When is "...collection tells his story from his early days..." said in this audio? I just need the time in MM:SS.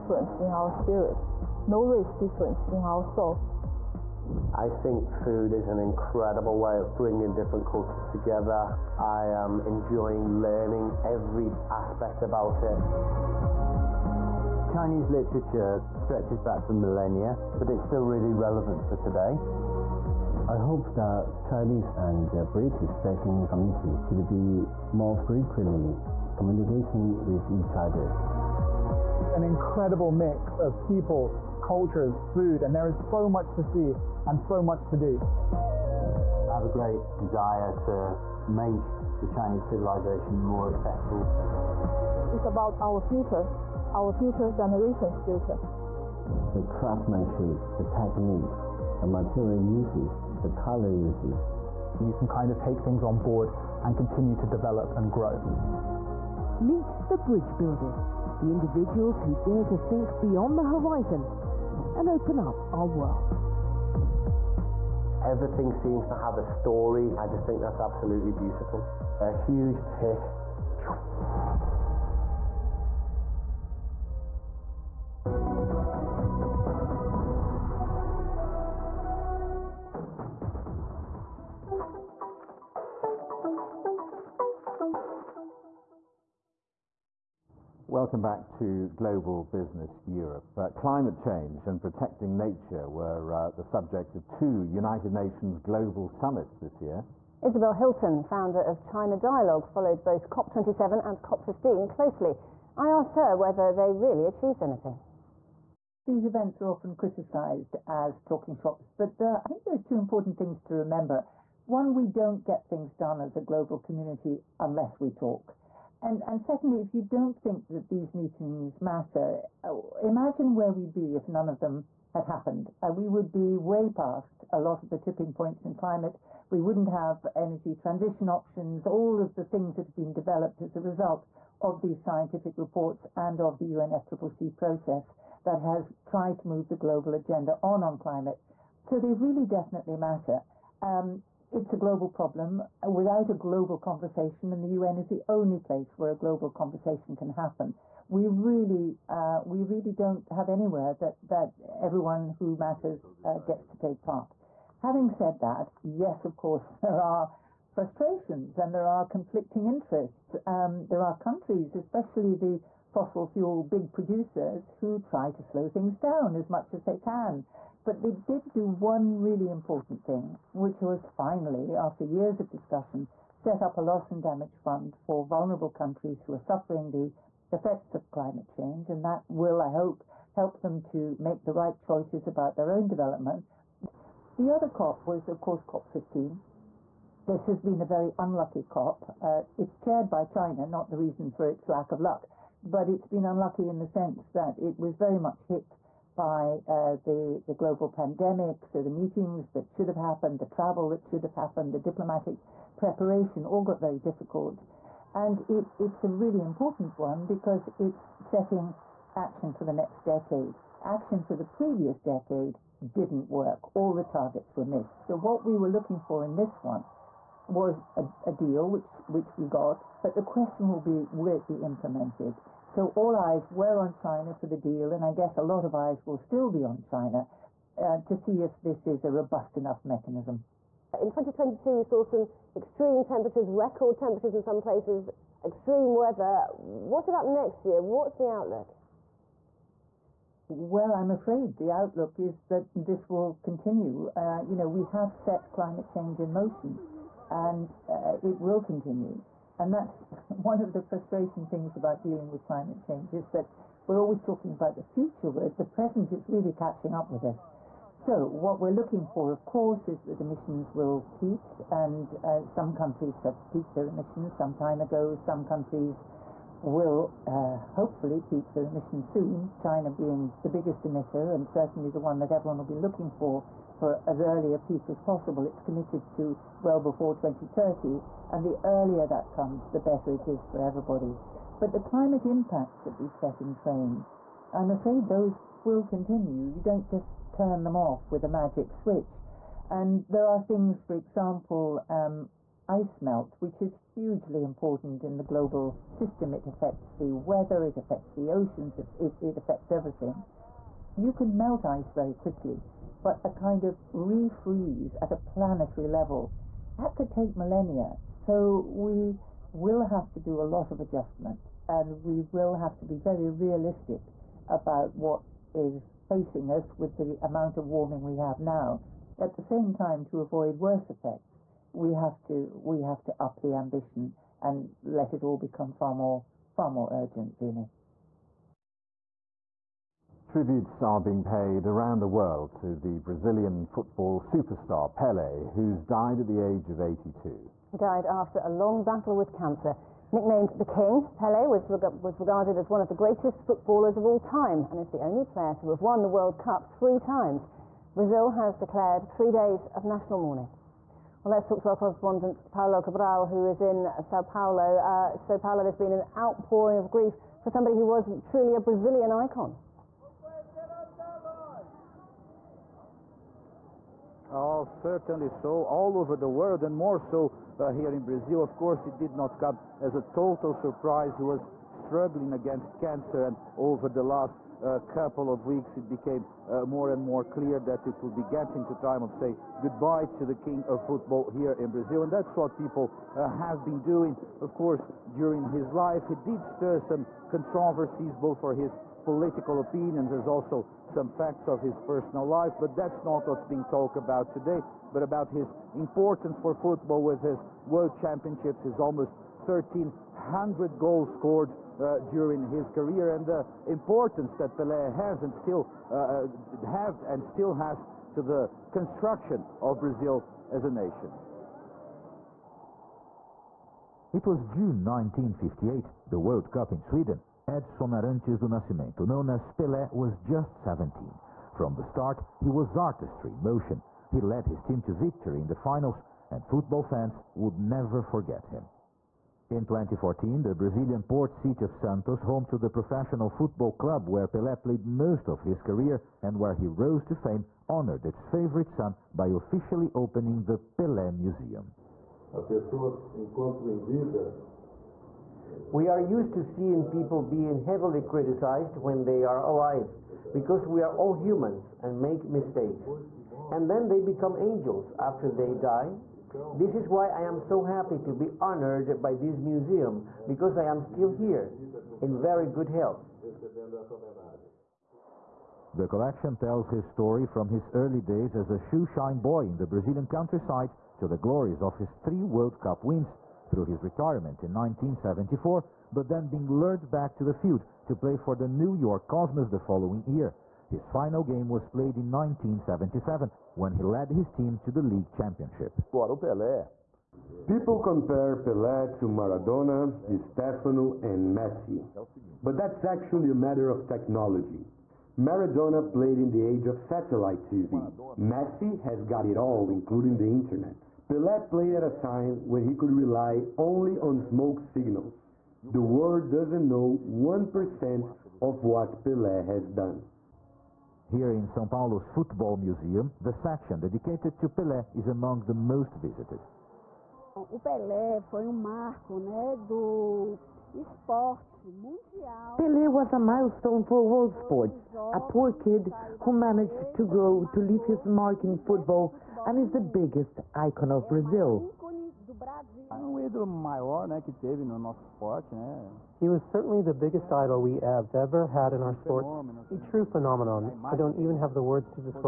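07:45.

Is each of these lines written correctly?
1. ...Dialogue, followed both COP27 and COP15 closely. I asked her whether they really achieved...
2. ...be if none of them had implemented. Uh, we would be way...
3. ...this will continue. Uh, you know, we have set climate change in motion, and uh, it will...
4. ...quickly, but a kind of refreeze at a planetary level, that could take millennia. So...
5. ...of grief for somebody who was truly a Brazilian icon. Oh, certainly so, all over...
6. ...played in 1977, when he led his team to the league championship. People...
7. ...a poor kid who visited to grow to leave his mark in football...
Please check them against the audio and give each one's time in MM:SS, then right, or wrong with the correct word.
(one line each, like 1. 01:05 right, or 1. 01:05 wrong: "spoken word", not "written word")
1. 01:39 right
2. 02:00 wrong: "happened", not "implemented"
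3. 04:02 right
4. 05:02 right
5. 05:56 right
6. 08:01 right
7. 08:45 wrong: "managed", not "visited".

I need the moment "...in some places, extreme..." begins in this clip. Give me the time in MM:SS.
03:54.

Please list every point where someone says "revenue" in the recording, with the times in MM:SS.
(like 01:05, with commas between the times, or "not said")
not said.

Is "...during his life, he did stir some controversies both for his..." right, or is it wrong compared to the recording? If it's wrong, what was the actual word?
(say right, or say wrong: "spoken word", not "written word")
right.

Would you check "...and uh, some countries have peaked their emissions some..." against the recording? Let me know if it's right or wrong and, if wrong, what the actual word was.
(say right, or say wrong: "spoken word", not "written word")
right.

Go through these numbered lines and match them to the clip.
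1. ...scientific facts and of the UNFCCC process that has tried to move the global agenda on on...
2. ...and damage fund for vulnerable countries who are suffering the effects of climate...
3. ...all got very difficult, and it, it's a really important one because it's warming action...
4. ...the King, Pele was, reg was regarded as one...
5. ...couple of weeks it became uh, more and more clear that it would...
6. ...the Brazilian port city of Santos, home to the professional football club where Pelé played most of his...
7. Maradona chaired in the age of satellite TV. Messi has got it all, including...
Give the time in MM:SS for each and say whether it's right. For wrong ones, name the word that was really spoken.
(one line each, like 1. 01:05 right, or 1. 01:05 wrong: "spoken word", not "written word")
1. 02:12 wrong: "reports", not "facts"
2. 02:54 right
3. 03:23 wrong: "setting", not "warming"
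4. 05:40 right
5. 06:14 right
6. 07:10 right
7. 08:15 wrong: "played", not "chaired".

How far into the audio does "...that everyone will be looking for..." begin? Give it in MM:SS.
04:32.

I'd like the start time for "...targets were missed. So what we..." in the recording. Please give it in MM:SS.
03:34.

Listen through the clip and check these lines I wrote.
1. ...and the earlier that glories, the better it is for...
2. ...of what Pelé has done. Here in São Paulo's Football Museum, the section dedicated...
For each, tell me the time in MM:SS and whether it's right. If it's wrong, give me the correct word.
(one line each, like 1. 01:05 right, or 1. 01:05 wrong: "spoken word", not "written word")
1. 04:38 wrong: "comes", not "glories"
2. 08:28 right.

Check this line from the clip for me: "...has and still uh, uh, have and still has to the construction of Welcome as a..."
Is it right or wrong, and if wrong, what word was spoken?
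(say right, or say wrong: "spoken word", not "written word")
wrong: "Brazil", not "Welcome".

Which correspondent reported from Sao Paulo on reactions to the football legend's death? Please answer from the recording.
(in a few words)
Paulo Cabral.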